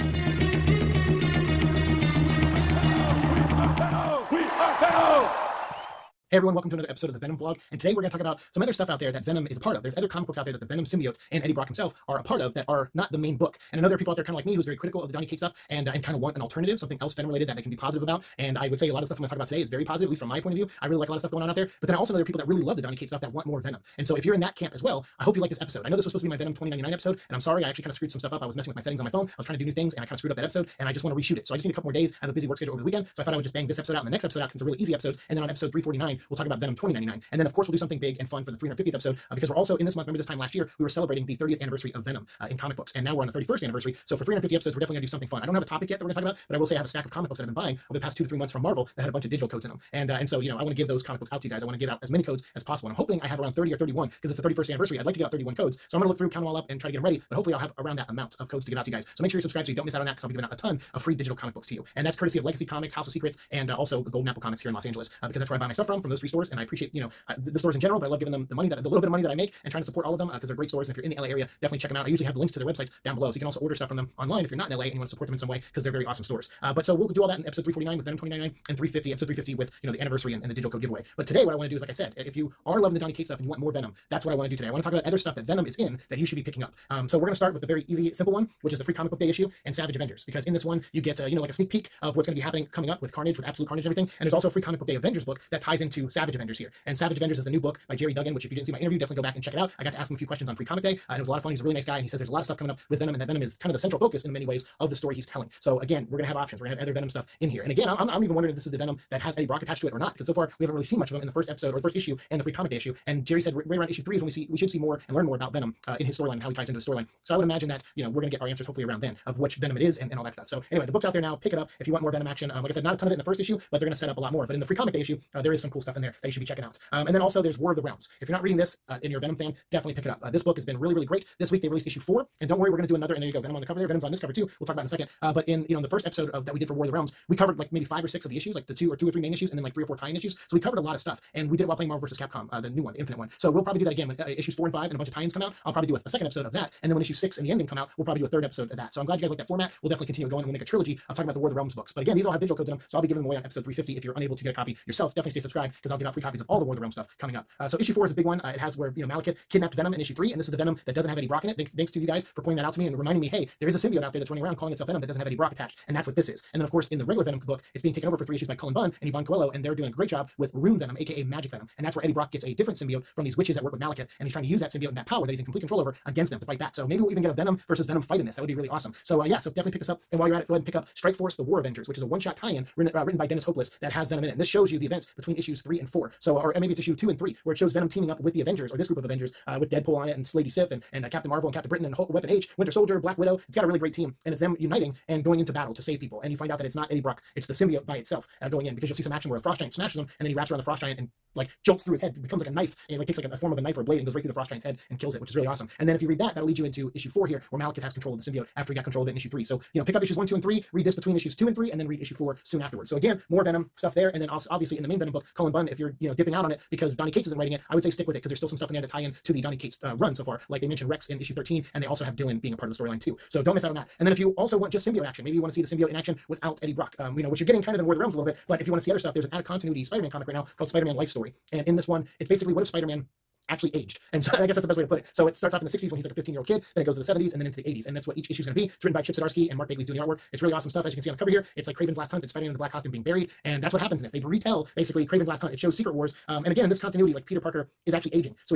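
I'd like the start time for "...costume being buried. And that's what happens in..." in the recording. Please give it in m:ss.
4:02.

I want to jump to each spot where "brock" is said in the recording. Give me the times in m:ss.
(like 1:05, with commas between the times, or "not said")
0:11, 1:49, 2:41, 2:45, 2:52, 3:16, 3:46.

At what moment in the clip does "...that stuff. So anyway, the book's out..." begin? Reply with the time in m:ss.
2:00.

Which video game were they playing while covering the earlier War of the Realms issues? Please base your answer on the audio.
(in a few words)
Marvel vs. Capcom.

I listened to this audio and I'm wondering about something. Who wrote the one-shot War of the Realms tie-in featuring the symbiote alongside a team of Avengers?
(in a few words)
Dennis Hopeless.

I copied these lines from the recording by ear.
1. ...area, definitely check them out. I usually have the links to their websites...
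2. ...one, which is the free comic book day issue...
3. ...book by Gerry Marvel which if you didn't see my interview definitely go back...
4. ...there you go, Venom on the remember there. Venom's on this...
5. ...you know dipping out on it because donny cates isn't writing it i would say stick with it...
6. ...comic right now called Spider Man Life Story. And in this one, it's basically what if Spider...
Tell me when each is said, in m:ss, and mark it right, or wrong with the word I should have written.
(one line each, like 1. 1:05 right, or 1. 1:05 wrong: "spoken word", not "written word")
1. 1:11 right
2. 1:28 right
3. 1:37 wrong: "Duggan", not "Marvel"
4. 2:13 wrong: "cover", not "remember"
5. 3:36 right
6. 3:50 right.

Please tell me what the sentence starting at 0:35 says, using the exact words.
And then on episode 349, we'll talk about Venom 2099.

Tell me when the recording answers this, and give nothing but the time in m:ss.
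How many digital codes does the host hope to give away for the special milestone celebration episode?
0:55.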